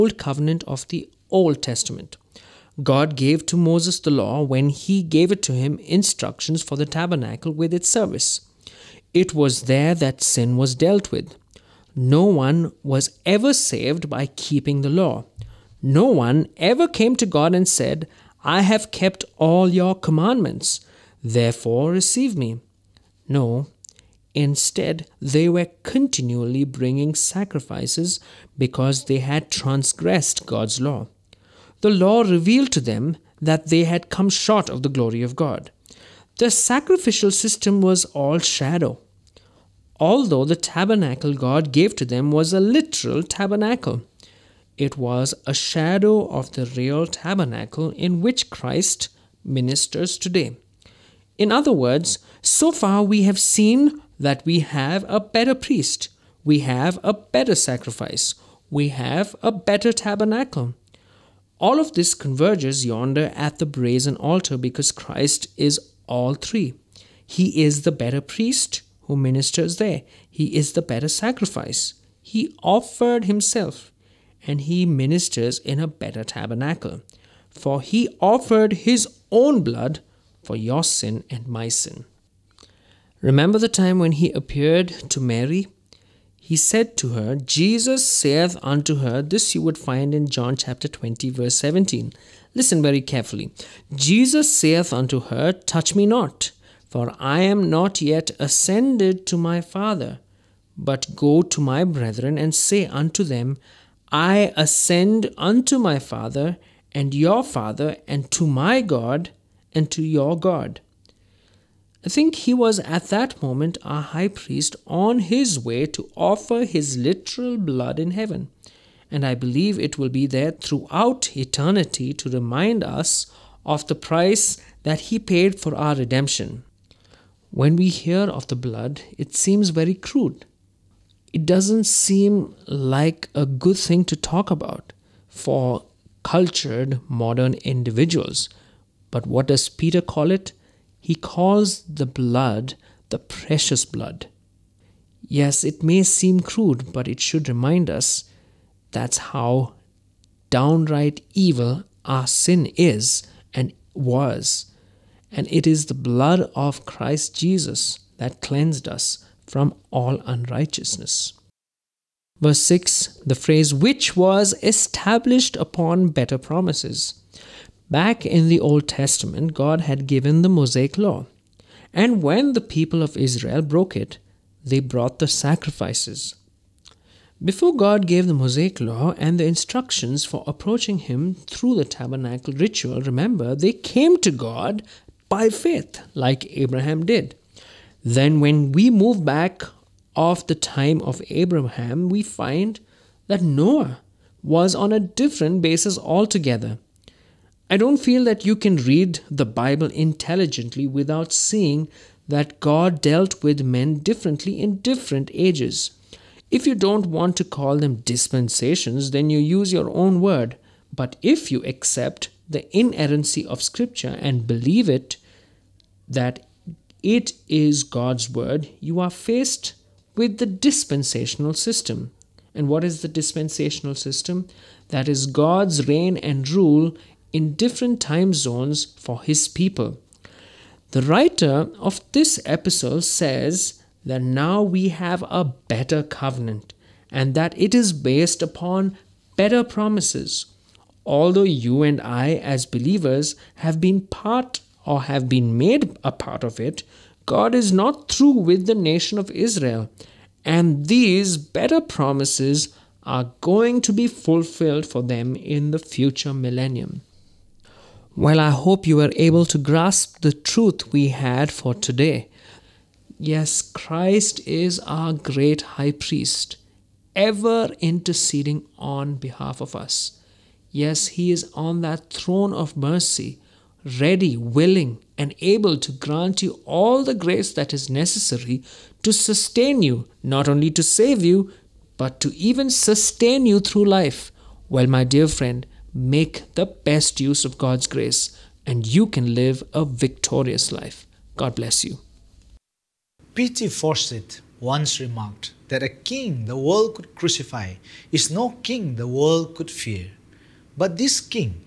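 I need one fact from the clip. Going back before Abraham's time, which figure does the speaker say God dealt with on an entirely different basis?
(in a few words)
Noah.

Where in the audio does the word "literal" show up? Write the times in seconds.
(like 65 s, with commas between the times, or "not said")
42 s, 116 s.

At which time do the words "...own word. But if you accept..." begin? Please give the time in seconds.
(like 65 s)
209 s.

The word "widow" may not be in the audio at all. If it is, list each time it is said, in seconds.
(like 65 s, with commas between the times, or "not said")
not said.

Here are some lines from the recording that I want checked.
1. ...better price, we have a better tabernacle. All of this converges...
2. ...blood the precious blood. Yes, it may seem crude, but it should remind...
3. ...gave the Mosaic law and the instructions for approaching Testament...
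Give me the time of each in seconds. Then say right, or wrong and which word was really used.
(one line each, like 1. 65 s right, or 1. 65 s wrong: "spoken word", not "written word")
1. 57 s wrong: "sacrifice", not "price"
2. 142 s right
3. 178 s wrong: "Him", not "Testament".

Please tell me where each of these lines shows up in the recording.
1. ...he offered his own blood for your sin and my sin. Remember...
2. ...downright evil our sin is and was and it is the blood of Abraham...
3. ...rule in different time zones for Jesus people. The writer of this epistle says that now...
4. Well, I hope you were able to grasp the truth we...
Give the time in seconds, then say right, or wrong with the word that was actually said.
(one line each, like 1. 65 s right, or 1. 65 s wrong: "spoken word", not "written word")
1. 77 s right
2. 150 s wrong: "Christ", not "Abraham"
3. 226 s wrong: "His", not "Jesus"
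4. 258 s right.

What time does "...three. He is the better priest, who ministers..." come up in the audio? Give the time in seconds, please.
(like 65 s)
66 s.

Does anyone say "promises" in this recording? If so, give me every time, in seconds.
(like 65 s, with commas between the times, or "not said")
166 s, 239 s, 251 s.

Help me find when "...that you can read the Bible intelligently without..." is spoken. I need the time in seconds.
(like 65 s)
198 s.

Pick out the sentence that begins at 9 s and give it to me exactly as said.
It was there that sin was dealt with.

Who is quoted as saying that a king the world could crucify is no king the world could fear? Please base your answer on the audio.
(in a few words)
P.T. Forsyth.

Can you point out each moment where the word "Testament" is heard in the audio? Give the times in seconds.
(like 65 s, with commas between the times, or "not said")
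1 s, 168 s.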